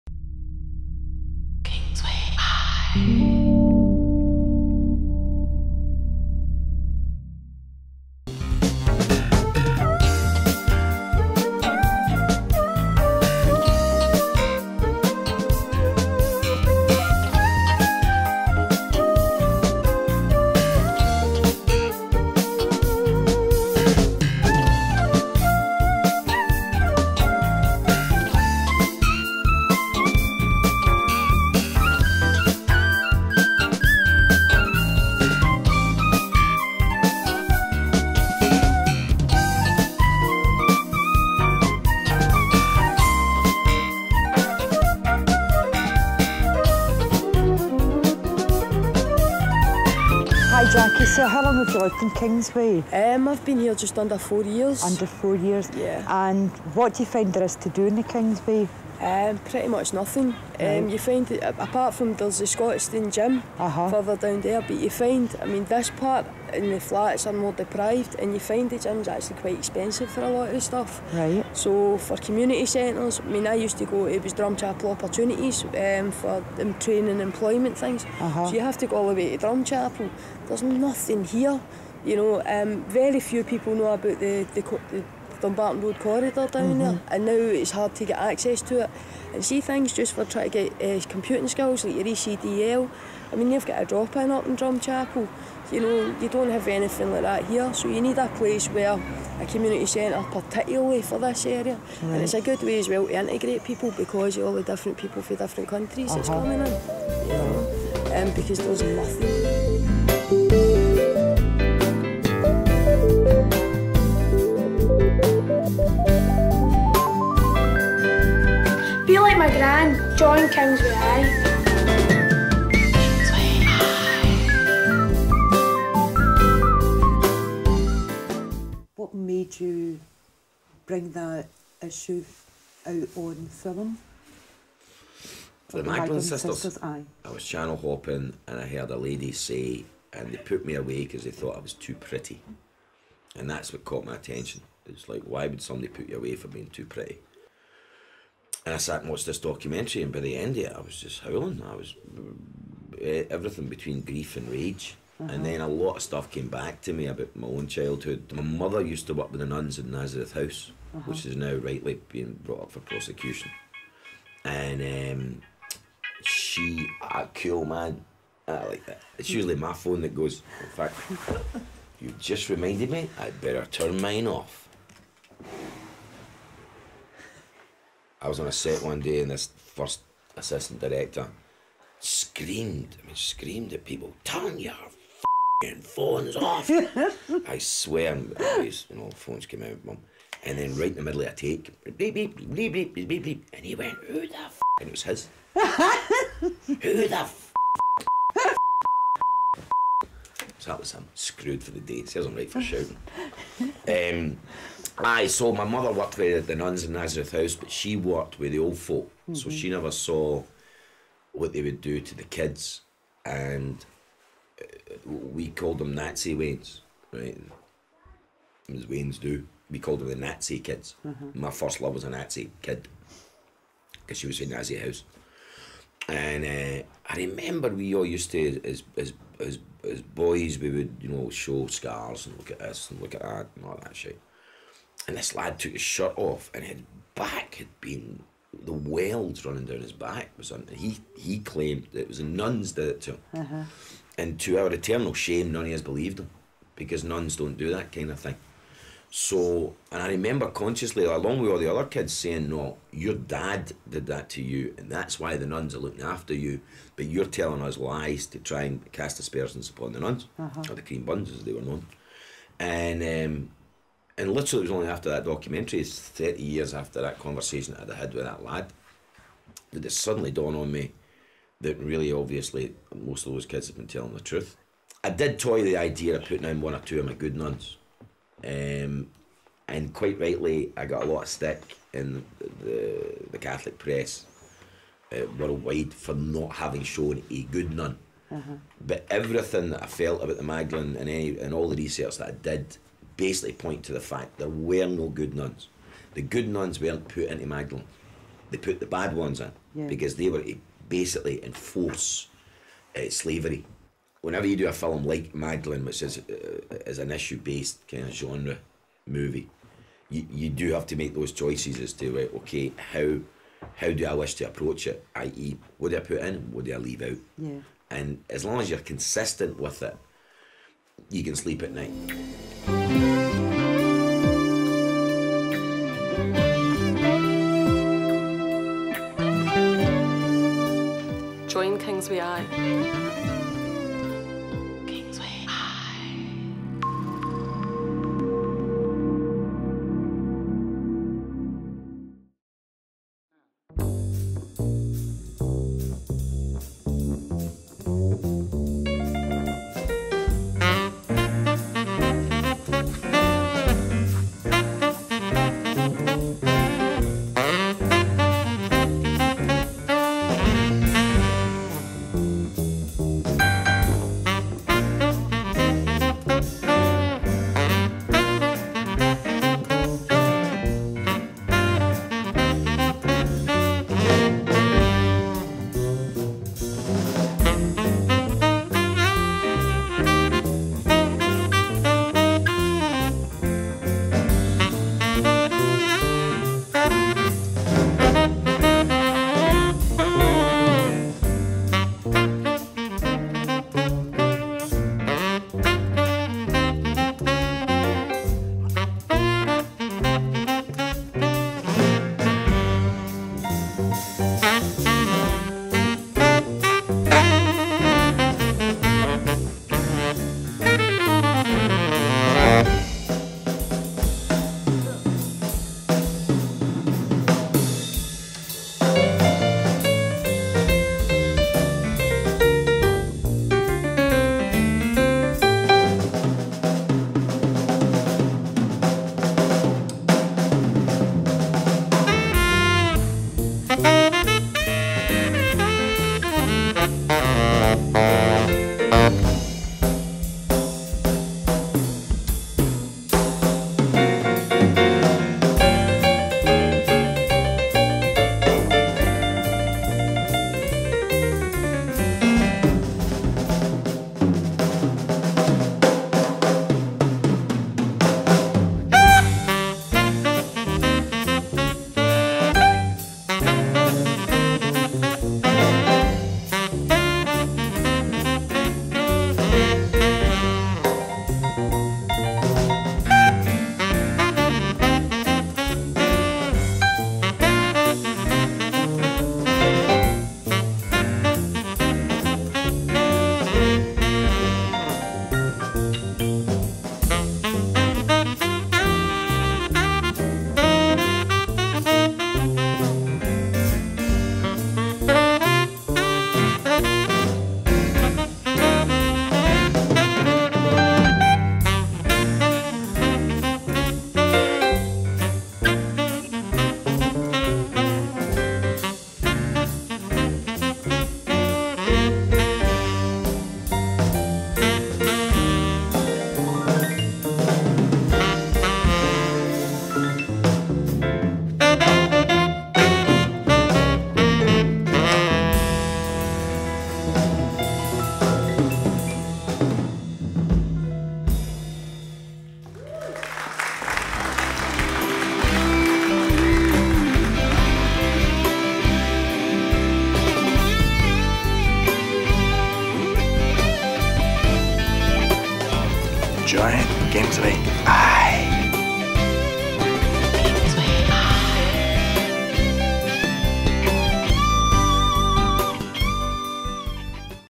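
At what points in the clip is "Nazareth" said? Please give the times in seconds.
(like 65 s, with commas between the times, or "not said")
159 s, 206 s.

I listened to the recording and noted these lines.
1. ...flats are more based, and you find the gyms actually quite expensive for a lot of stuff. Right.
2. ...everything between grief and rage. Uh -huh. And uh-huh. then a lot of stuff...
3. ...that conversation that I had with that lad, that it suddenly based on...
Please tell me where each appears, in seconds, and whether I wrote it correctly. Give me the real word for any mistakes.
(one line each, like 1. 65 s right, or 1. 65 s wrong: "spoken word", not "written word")
1. 66 s wrong: "deprived", not "based"
2. 153 s right
3. 267 s wrong: "dawned", not "based".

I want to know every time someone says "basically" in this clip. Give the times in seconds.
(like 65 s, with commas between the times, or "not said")
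293 s, 300 s.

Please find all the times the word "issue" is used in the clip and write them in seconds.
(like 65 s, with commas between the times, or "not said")
131 s, 307 s.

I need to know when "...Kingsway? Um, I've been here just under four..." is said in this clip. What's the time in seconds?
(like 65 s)
52 s.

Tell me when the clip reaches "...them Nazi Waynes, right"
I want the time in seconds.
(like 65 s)
215 s.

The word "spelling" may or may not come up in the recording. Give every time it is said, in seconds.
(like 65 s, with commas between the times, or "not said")
not said.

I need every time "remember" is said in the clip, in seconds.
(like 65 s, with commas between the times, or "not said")
227 s, 250 s.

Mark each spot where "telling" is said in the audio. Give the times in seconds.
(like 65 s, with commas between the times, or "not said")
257 s, 273 s.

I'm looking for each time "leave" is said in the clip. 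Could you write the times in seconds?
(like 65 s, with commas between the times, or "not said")
316 s.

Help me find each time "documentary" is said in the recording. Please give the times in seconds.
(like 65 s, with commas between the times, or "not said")
149 s, 265 s.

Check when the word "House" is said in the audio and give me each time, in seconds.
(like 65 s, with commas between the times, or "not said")
160 s, 207 s, 224 s.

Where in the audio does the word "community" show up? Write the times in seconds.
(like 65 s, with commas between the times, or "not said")
72 s, 99 s.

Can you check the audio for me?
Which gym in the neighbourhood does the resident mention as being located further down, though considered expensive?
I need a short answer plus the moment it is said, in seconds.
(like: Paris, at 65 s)
Scottish Dean Gym, at 62 s.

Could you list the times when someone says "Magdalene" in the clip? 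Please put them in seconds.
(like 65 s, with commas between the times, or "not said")
135 s, 290 s, 297 s, 305 s.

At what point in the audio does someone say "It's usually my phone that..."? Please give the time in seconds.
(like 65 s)
169 s.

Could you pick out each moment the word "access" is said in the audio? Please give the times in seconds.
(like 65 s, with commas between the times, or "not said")
88 s.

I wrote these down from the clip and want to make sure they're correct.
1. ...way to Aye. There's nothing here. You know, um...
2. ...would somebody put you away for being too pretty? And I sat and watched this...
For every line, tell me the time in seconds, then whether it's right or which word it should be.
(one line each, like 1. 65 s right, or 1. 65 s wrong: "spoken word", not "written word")
1. 79 s wrong: "Drumchapel", not "Aye"
2. 145 s right.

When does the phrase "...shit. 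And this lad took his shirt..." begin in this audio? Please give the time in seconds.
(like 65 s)
233 s.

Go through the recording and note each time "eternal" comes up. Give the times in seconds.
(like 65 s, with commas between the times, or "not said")
244 s.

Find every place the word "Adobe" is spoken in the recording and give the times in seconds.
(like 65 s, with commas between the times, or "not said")
not said.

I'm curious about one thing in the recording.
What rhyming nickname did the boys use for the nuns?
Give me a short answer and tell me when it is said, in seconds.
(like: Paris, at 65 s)
The cream buns, at 260 s.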